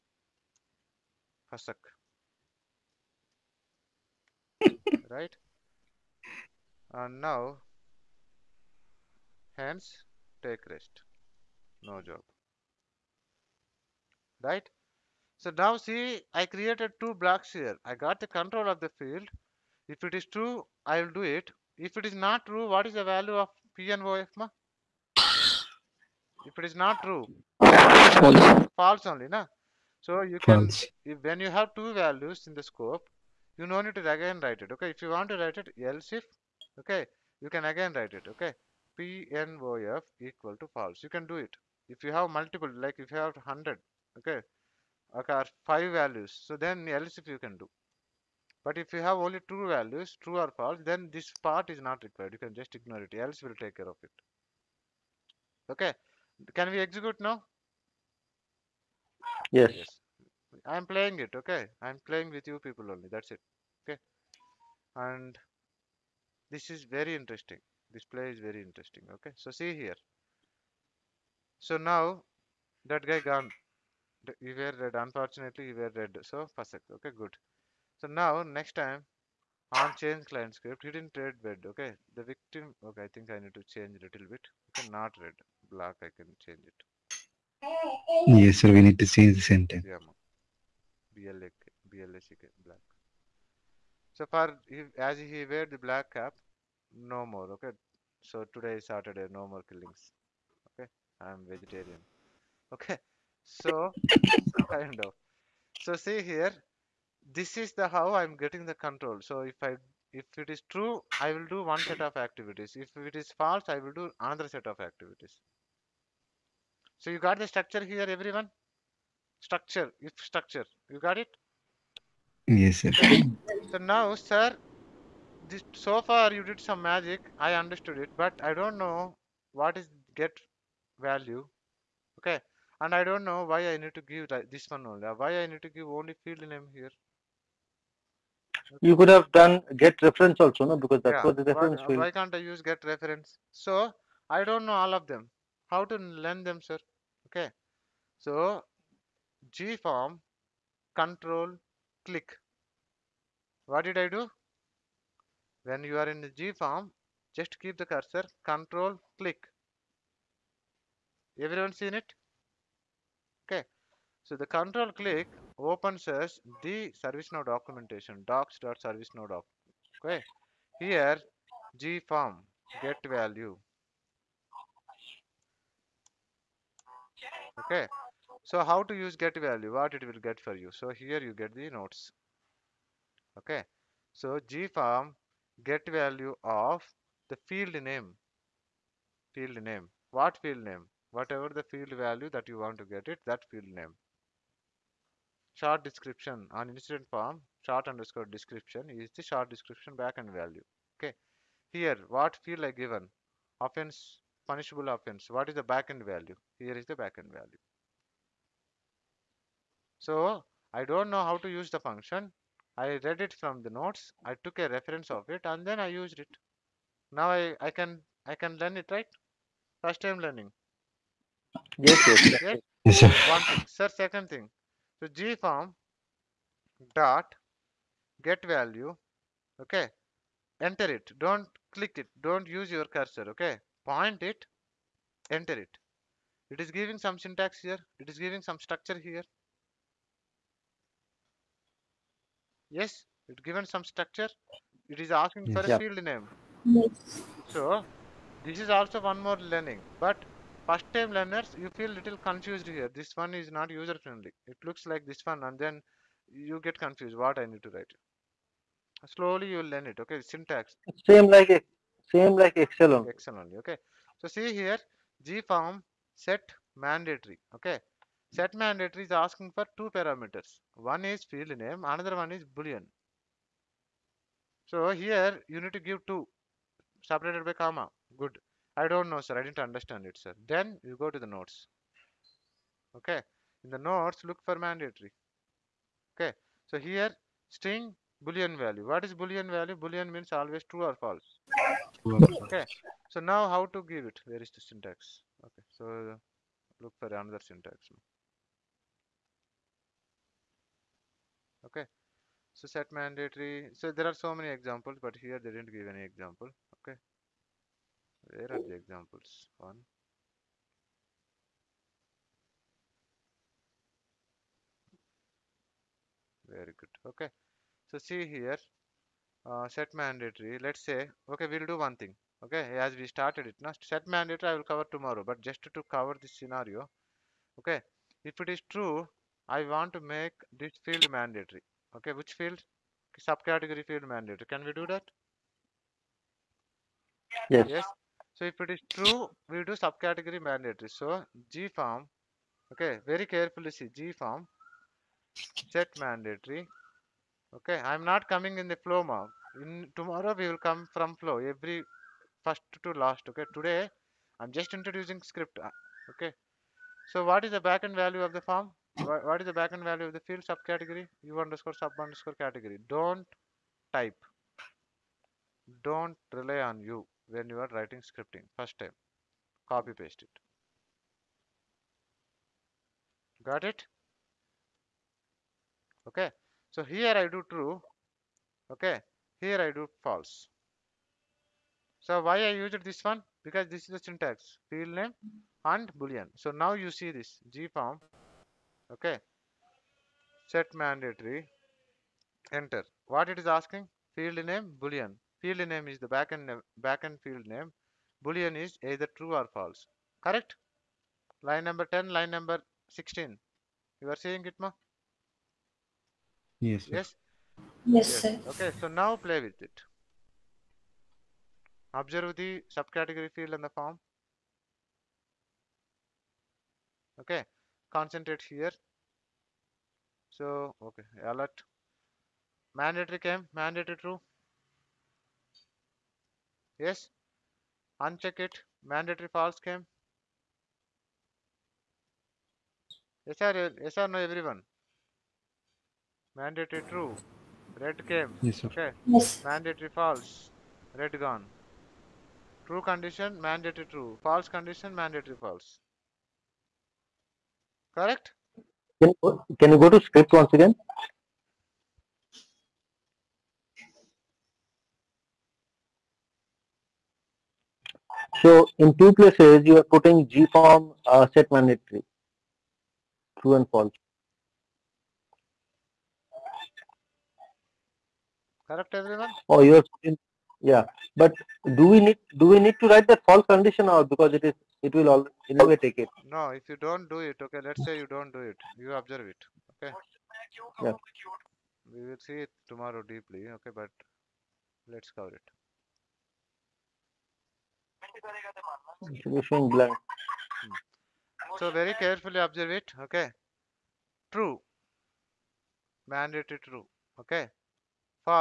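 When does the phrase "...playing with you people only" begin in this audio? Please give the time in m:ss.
1:02.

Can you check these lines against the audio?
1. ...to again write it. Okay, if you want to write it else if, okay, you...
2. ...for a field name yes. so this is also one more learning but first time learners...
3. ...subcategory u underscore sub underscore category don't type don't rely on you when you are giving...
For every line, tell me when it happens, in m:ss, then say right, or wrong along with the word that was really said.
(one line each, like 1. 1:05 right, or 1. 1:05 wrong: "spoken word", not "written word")
1. 0:33 right
2. 4:05 right
3. 6:00 wrong: "writing", not "giving".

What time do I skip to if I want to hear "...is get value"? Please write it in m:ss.
2:09.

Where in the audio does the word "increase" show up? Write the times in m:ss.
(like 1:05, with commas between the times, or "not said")
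not said.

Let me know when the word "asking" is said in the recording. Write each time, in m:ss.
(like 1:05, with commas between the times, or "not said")
4:05, 4:29, 6:33.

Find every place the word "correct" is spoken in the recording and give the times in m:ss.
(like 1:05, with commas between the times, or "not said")
6:40, 7:27, 7:48.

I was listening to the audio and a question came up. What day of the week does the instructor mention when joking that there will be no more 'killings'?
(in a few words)
Saturday.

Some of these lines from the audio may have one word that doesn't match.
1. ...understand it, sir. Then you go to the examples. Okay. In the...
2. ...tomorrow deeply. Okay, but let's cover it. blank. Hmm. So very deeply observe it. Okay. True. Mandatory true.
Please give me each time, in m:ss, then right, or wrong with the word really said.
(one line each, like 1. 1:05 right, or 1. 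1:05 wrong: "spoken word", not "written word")
1. 4:39 wrong: "notes", not "examples"
2. 8:02 wrong: "carefully", not "deeply".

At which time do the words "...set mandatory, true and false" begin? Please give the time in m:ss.
7:41.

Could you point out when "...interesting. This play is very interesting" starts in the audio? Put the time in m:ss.
1:07.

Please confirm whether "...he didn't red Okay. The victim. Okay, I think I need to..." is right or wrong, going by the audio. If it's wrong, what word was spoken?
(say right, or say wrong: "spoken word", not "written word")
right.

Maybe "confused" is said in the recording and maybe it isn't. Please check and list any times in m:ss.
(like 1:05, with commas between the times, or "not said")
4:12, 4:16.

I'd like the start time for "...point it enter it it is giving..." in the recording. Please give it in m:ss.
3:53.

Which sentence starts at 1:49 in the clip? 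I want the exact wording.
So if I if it is true, I will do one set of activities.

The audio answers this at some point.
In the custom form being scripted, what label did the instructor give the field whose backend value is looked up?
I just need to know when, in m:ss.
3:24.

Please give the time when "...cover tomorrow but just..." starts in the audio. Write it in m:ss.
5:24.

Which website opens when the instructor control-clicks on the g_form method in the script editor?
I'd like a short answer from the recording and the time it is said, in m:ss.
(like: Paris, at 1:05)
docs.servicenow.com, at 2:48.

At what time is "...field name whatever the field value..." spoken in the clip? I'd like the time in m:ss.
3:10.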